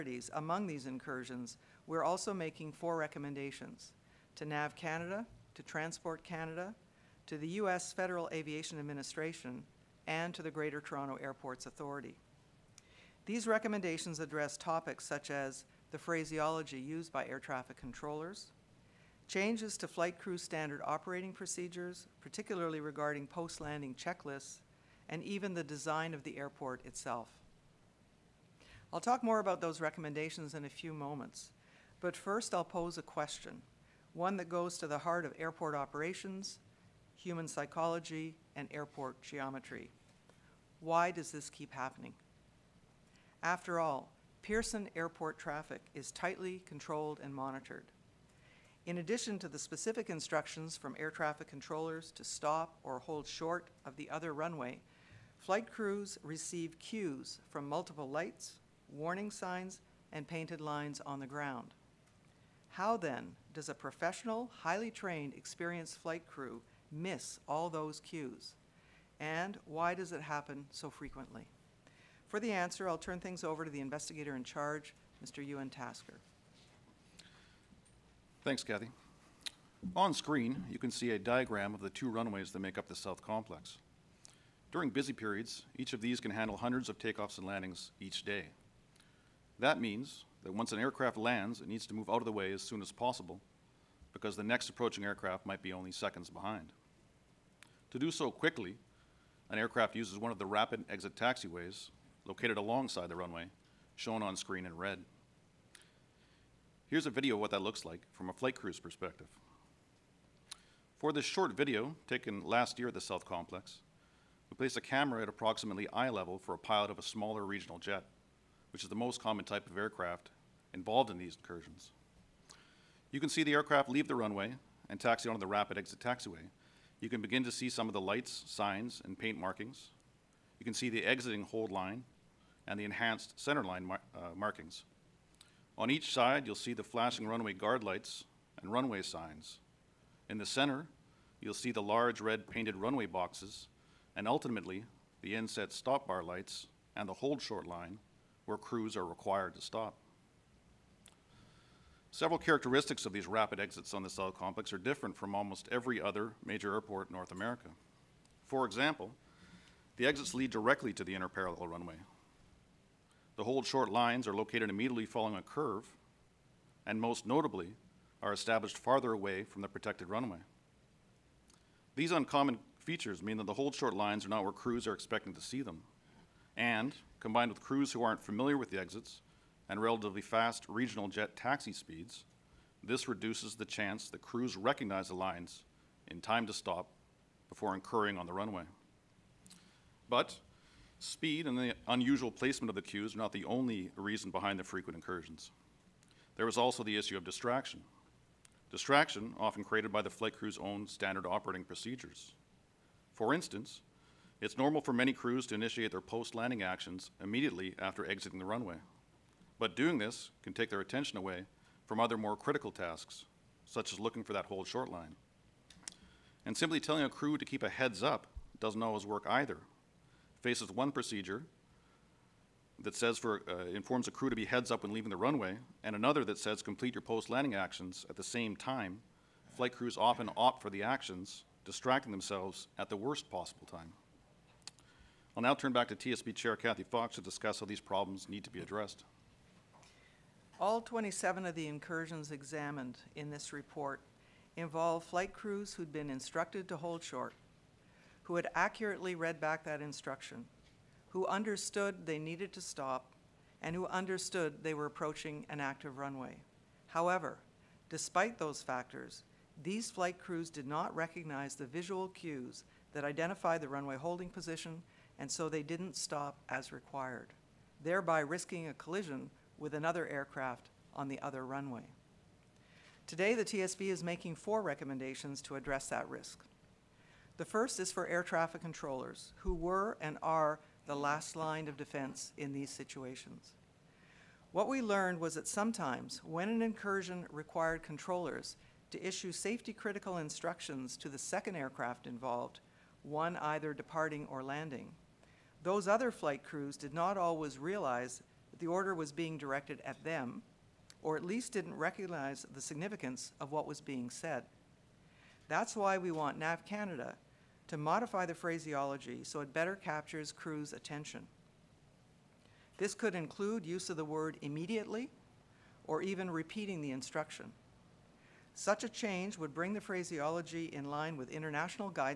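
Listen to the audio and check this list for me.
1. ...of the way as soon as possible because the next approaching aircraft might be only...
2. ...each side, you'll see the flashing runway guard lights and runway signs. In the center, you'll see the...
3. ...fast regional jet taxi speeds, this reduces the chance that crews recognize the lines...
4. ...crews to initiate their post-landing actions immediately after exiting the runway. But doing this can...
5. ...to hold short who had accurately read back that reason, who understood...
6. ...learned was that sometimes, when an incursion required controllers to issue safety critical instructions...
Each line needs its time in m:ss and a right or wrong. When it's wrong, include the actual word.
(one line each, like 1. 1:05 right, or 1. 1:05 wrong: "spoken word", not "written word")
1. 1:32 right
2. 2:15 right
3. 3:00 right
4. 3:25 right
5. 4:06 wrong: "instruction", not "reason"
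6. 4:44 right.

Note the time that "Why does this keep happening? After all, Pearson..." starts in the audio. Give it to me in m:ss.
0:40.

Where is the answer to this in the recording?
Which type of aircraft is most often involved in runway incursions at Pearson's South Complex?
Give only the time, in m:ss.
1:57.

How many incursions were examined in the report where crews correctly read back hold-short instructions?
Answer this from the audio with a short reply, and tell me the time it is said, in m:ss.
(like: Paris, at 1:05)
27, at 4:00.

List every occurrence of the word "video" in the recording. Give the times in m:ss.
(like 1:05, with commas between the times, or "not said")
1:47, 1:51.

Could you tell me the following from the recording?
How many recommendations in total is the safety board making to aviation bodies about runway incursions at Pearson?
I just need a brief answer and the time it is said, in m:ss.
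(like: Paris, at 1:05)
4, at 0:02.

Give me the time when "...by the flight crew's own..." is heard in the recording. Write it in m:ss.
3:19.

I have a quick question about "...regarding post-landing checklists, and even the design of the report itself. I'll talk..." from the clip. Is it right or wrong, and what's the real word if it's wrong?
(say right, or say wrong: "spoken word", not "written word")
wrong: "airport", not "report".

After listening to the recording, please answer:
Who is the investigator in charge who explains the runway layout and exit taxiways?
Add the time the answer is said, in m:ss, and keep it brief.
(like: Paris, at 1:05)
Ewan Tasker, at 1:15.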